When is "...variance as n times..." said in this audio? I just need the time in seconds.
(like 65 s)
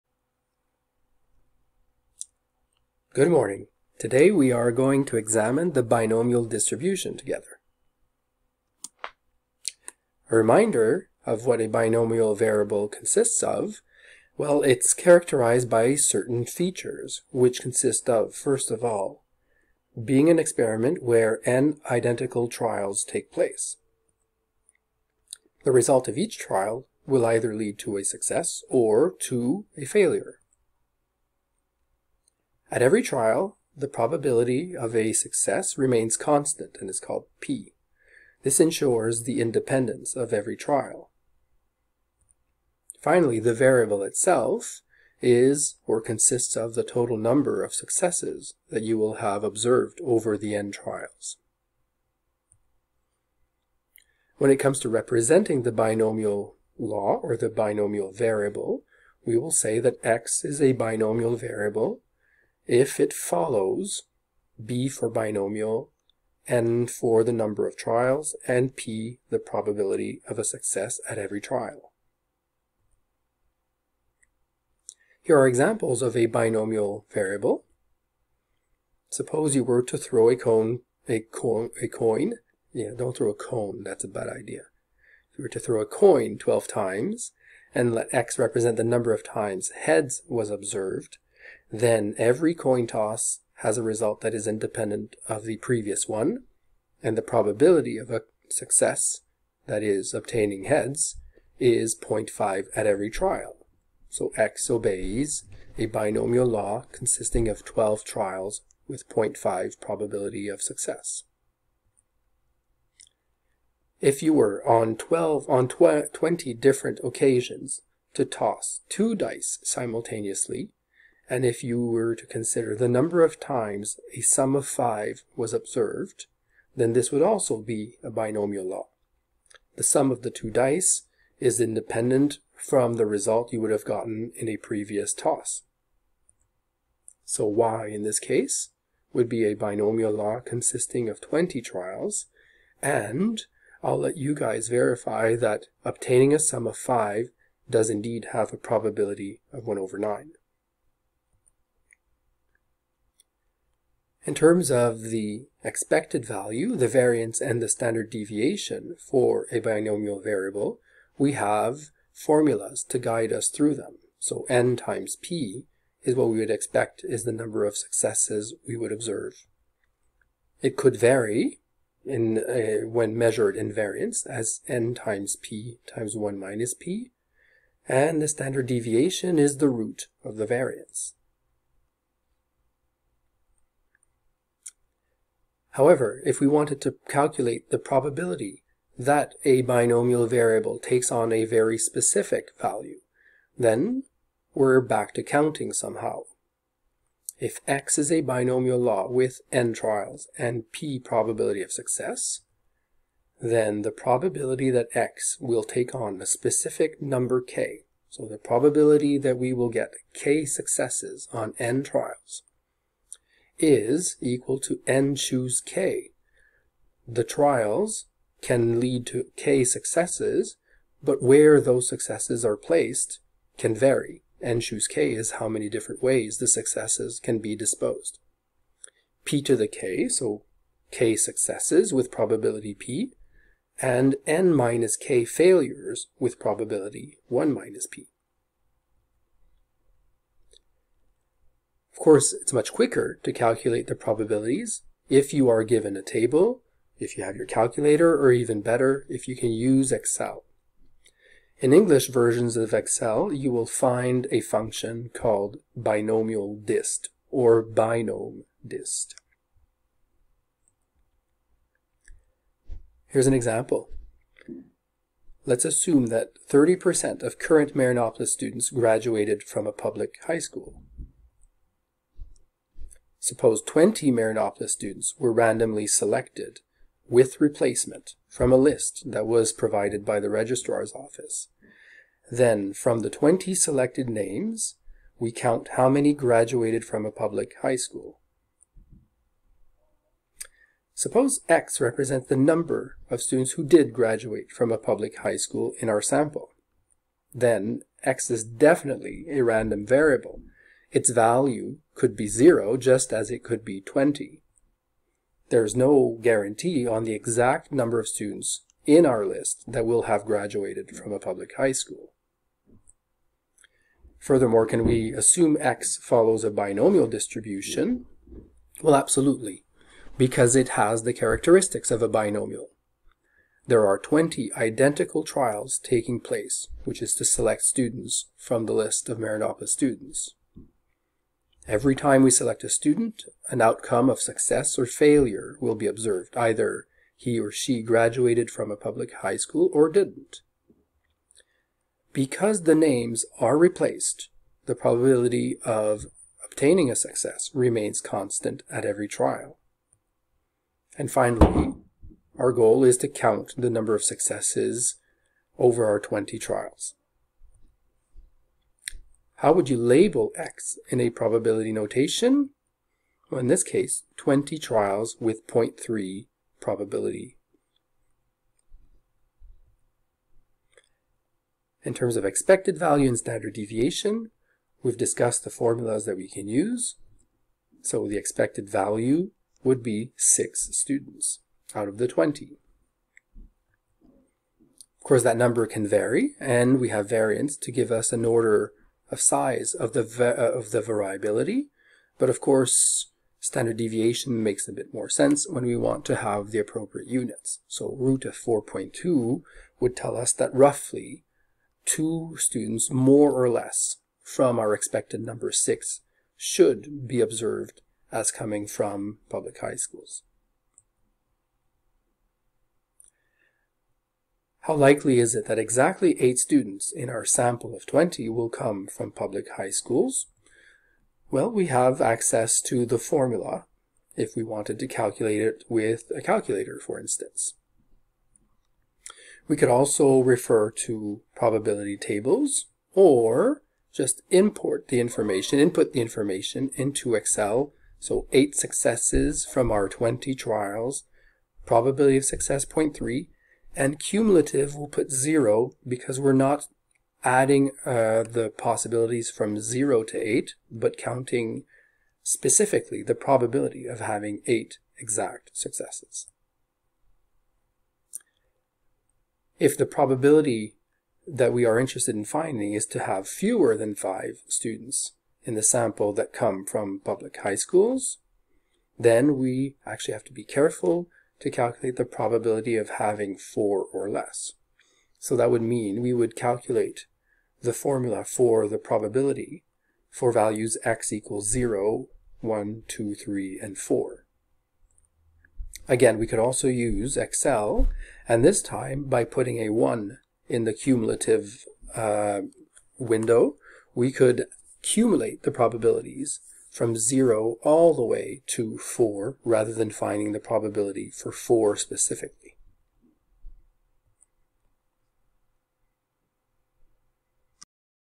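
173 s.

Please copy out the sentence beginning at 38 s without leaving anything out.
This ensures the independence of every trial.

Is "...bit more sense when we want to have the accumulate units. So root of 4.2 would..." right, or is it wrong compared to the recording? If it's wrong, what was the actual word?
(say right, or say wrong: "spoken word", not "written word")
wrong: "appropriate", not "accumulate".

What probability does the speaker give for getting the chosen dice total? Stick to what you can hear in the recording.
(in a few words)
1/9.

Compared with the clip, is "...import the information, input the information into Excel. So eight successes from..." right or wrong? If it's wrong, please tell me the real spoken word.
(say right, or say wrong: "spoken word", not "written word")
right.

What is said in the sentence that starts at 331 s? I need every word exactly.
Every time we select a student, an outcome of success or failure will be observed.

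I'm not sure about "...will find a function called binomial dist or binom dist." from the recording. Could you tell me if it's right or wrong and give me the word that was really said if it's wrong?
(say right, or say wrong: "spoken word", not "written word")
right.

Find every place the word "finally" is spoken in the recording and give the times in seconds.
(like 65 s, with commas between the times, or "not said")
43 s, 351 s.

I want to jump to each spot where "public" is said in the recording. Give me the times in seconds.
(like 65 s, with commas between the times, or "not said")
269 s, 287 s, 294 s, 311 s, 338 s, 409 s, 419 s, 467 s.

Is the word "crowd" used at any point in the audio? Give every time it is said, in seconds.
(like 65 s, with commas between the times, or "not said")
not said.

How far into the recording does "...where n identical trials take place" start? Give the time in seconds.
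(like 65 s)
21 s.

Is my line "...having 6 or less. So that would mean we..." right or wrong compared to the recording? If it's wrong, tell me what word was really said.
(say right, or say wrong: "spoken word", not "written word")
wrong: "4", not "6".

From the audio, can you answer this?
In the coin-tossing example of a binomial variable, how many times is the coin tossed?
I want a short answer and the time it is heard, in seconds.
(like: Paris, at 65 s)
12, at 86 s.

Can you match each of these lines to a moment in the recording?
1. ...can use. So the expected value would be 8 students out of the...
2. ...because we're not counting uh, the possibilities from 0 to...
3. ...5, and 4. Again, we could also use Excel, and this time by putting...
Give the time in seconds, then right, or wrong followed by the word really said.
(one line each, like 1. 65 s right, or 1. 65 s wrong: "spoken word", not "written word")
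1. 376 s wrong: "6", not "8"
2. 445 s wrong: "adding", not "counting"
3. 483 s wrong: "3", not "5".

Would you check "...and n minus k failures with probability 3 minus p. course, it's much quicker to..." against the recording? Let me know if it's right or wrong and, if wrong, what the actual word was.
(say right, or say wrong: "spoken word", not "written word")
wrong: "1", not "3".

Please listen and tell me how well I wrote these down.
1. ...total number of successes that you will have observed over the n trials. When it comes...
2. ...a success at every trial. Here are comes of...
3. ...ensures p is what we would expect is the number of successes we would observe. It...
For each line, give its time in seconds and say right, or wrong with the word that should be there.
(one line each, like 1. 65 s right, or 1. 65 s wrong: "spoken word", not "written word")
1. 46 s right
2. 70 s wrong: "examples", not "comes"
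3. 164 s wrong: "times", not "ensures".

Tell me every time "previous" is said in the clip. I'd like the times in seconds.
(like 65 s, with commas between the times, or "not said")
95 s, 134 s.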